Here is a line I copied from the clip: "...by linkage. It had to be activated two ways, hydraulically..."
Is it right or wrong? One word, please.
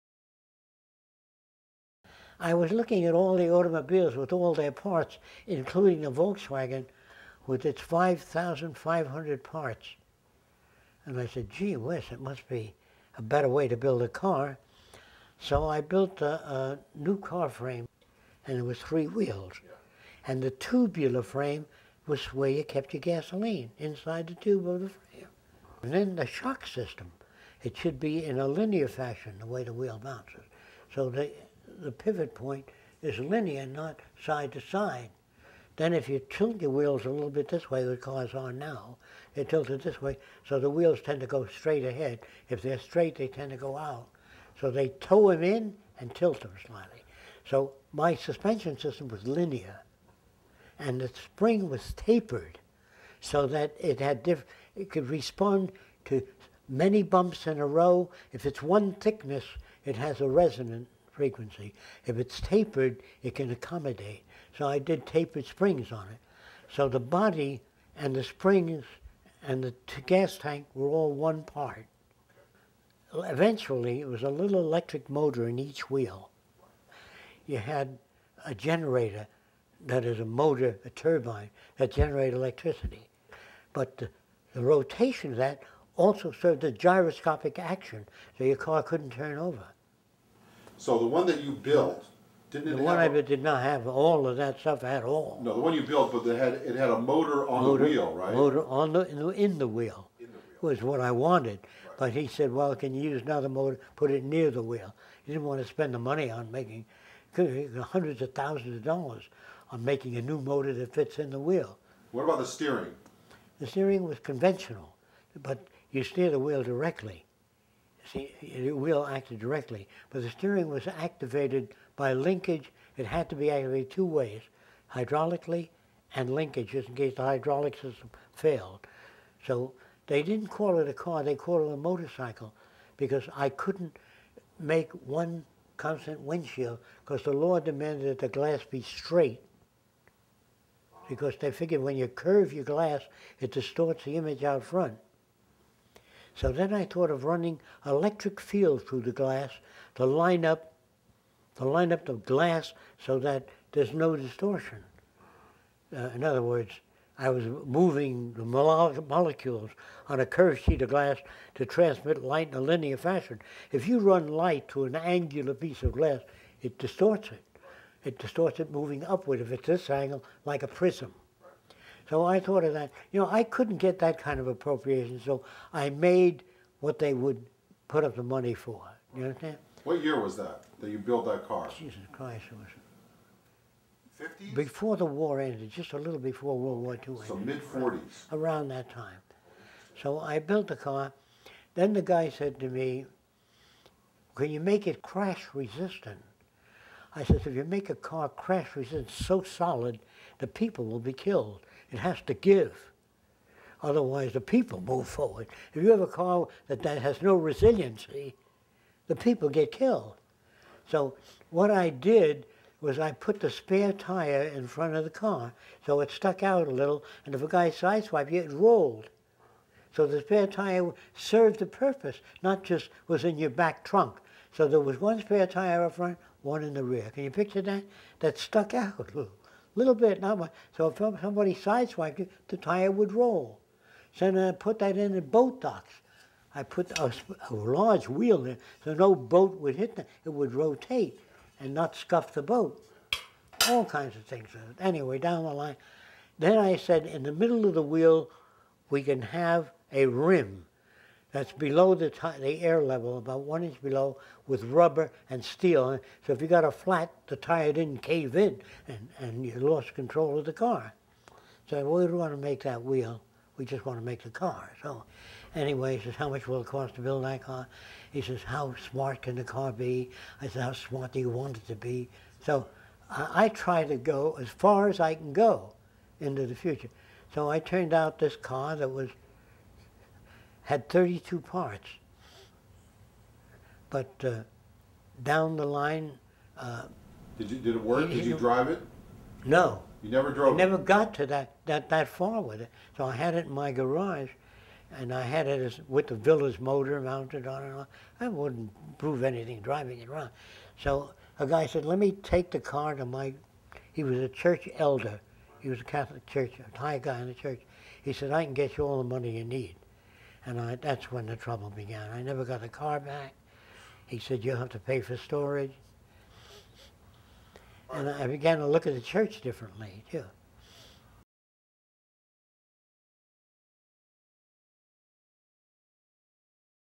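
right.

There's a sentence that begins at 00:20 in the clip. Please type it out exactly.
And the tubular frame was where you kept your gasoline, inside the tube of the frame.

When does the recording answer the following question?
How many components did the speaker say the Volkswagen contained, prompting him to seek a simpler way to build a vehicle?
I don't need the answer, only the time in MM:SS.
00:07.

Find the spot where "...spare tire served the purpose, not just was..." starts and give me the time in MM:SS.
03:40.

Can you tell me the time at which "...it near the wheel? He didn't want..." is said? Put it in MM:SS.
01:44.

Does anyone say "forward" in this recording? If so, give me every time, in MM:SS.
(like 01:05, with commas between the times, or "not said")
03:25.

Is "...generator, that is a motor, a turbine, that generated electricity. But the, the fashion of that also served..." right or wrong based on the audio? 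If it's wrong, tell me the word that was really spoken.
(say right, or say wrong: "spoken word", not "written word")
wrong: "rotation", not "fashion".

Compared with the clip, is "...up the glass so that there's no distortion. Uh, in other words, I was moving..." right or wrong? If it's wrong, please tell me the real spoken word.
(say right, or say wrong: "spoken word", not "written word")
right.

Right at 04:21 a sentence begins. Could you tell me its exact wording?
So we don't want to make that wheel.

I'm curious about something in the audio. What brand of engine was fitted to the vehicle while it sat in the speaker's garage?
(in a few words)
Villiers.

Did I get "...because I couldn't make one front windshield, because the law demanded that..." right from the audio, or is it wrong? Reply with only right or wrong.
wrong.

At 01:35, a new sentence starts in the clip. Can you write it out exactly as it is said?
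No, the one you built, but it had, it had a motor on the wheel, right?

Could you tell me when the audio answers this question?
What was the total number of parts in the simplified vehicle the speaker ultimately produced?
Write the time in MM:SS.
04:40.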